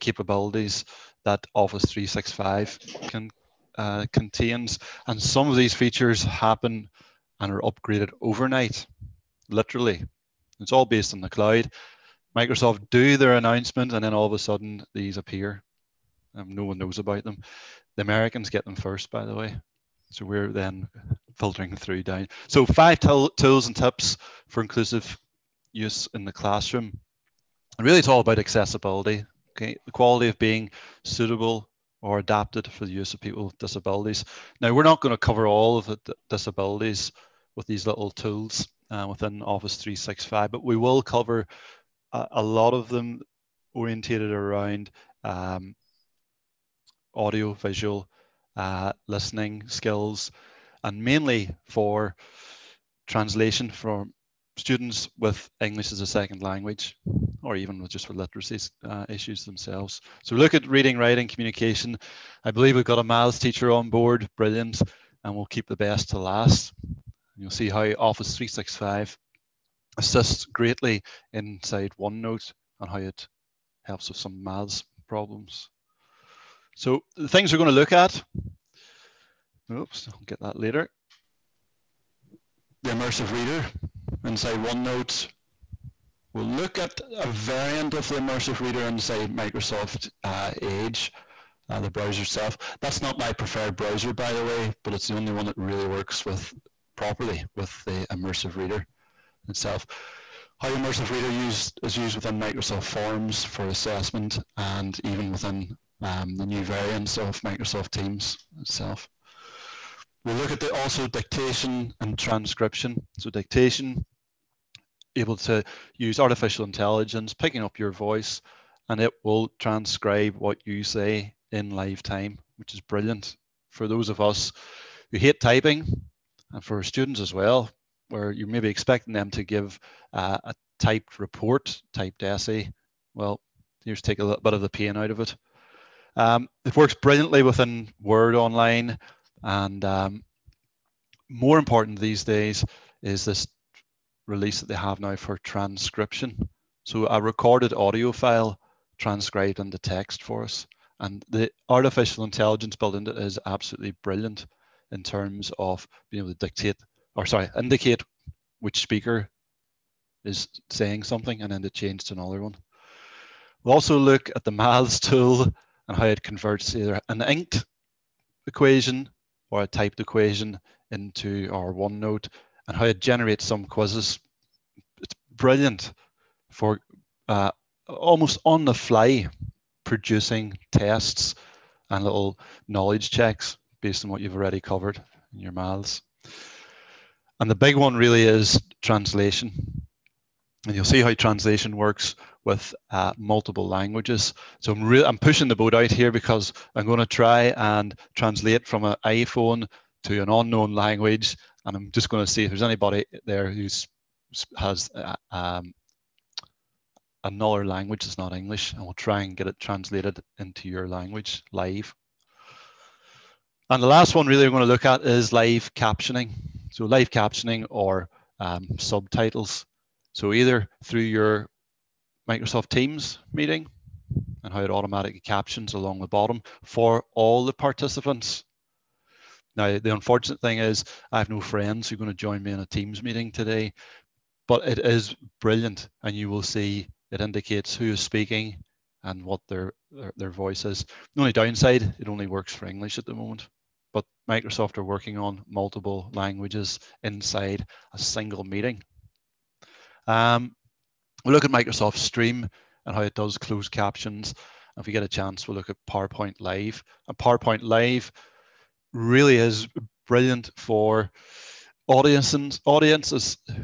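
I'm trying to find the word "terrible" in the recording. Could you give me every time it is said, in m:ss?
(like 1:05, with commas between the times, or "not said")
not said.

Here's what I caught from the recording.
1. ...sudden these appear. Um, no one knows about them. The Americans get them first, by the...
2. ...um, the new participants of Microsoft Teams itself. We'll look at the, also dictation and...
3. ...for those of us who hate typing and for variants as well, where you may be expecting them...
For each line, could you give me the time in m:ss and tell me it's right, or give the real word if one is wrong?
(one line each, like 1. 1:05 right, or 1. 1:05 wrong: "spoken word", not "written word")
1. 0:14 right
2. 1:46 wrong: "variants", not "participants"
3. 2:03 wrong: "students", not "variants".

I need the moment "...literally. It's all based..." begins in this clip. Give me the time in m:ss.
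0:09.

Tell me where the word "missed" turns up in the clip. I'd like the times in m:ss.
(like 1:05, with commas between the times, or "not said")
not said.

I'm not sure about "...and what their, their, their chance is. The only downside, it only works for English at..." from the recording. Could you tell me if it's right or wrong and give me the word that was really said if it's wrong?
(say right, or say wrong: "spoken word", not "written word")
wrong: "voice", not "chance".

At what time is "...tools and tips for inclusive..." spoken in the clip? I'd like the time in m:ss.
0:22.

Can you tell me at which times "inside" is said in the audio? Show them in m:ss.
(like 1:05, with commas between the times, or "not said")
1:11, 1:24, 1:28, 4:07.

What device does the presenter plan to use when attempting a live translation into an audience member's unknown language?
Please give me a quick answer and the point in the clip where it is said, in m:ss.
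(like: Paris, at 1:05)
iPhone, at 3:19.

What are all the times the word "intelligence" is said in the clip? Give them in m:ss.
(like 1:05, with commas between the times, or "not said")
1:56, 2:32.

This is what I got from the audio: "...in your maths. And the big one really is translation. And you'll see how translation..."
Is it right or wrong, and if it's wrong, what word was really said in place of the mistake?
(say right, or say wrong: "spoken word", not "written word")
right.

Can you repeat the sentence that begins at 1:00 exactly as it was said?
So look at reading, writing, communication.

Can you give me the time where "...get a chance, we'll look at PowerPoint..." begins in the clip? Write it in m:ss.
4:14.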